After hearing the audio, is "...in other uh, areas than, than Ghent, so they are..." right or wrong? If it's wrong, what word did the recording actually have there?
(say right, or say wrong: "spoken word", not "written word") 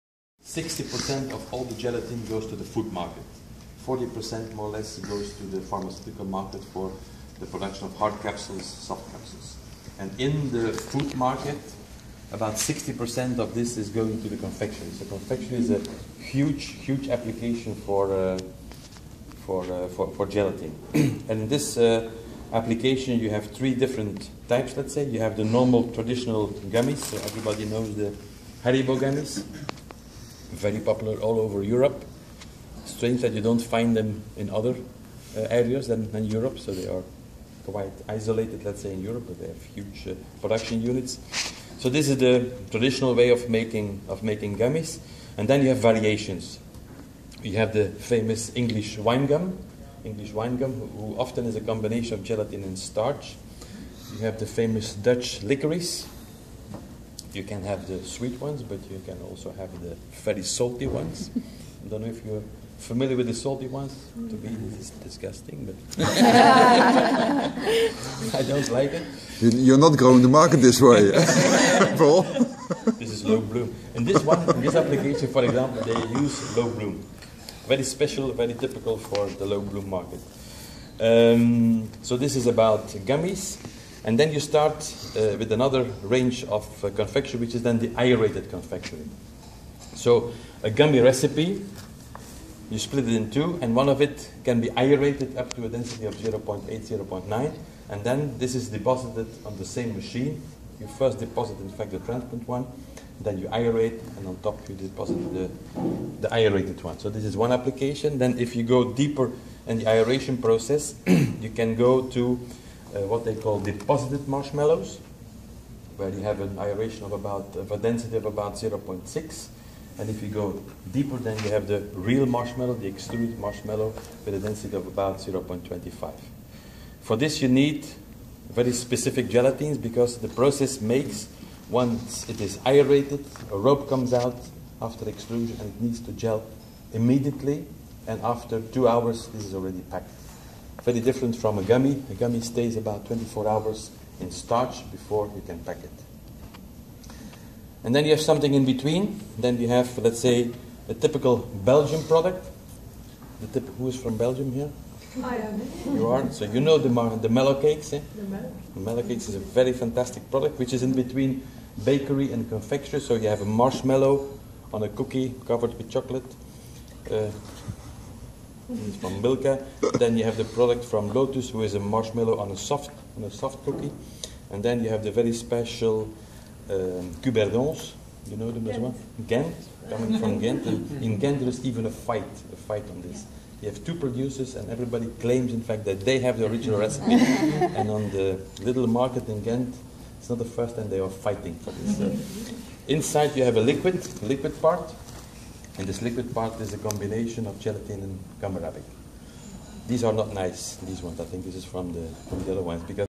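wrong: "Europe", not "Ghent".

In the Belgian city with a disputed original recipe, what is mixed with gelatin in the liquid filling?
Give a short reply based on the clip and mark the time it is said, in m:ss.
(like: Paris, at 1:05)
gum arabic, at 3:18.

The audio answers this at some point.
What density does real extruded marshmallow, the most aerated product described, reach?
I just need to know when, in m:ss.
2:05.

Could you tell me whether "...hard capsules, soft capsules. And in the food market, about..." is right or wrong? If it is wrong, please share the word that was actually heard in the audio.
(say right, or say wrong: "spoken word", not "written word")
right.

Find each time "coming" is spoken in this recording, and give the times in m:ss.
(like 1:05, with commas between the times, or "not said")
2:59.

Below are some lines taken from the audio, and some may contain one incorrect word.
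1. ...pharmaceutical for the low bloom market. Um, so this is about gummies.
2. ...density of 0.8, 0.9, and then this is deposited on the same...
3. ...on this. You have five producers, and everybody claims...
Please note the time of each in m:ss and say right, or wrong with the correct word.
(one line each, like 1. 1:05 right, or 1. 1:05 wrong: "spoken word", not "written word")
1. 1:18 wrong: "typical", not "pharmaceutical"
2. 1:35 right
3. 3:02 wrong: "two", not "five".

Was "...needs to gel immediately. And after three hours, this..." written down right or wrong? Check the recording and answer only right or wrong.
wrong.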